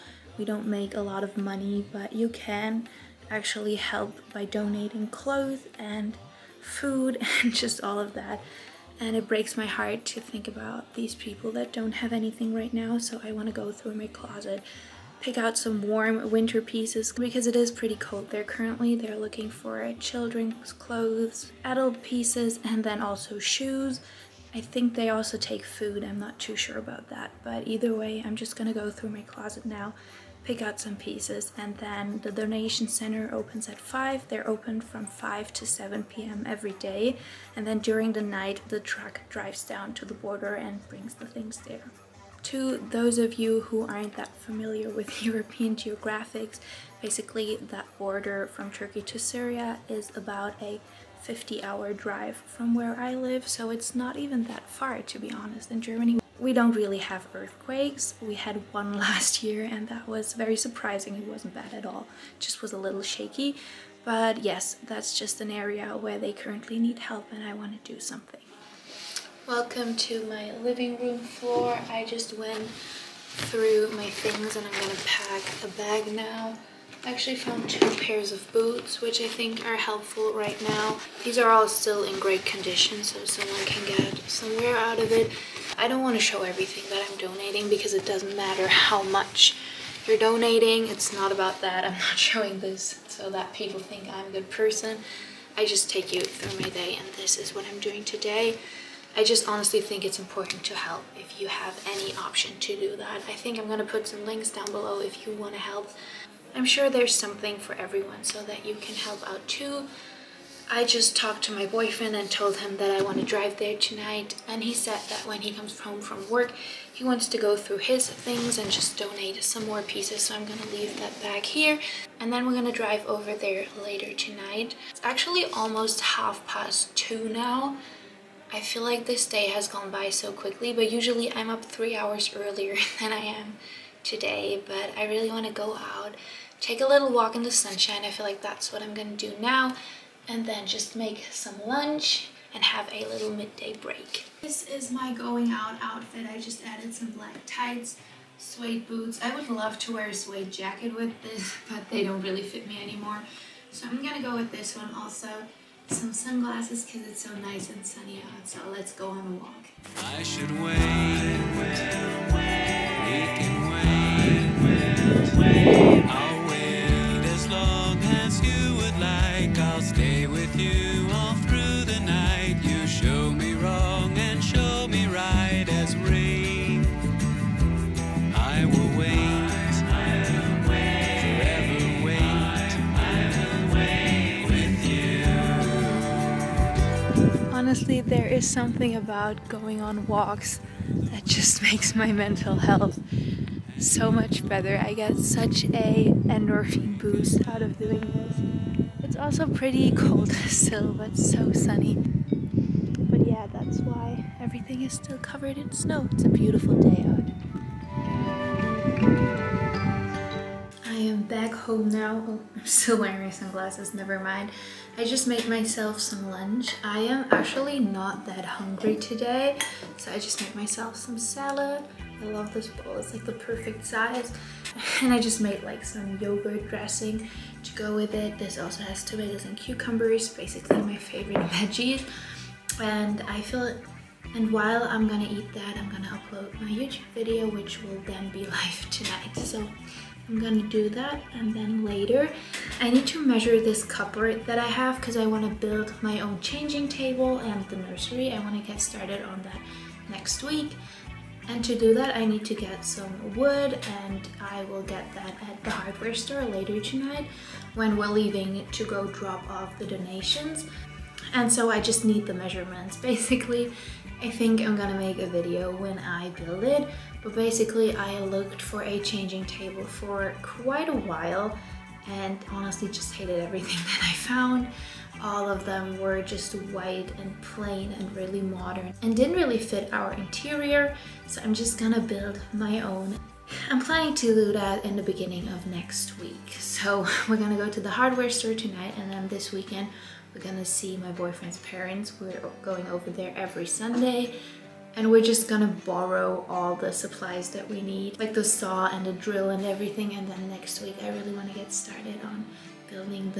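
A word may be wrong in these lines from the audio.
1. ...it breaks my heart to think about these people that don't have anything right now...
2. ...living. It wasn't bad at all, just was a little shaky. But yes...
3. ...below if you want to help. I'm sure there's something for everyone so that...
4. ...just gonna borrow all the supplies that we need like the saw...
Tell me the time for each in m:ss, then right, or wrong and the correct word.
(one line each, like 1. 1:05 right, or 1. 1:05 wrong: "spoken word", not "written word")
1. 0:09 right
2. 1:00 wrong: "surprising", not "living"
3. 1:44 right
4. 4:55 right.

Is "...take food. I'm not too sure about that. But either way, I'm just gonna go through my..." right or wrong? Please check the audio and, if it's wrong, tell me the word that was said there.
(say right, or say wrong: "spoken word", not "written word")
right.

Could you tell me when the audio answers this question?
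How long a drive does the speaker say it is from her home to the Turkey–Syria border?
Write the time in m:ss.
0:51.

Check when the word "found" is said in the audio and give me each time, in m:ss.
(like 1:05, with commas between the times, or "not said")
1:17, 4:34.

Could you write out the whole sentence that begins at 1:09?
Welcome to my living room floor.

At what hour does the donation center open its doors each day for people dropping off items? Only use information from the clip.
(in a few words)
5.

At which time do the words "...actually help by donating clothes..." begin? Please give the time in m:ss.
0:03.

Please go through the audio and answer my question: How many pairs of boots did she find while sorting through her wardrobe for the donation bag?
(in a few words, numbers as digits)
2.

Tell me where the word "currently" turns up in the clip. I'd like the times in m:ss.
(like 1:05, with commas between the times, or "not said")
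0:18, 1:06.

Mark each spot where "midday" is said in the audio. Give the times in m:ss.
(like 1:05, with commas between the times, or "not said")
2:23.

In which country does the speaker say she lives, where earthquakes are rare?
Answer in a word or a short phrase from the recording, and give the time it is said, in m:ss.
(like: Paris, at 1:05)
Germany, at 0:55.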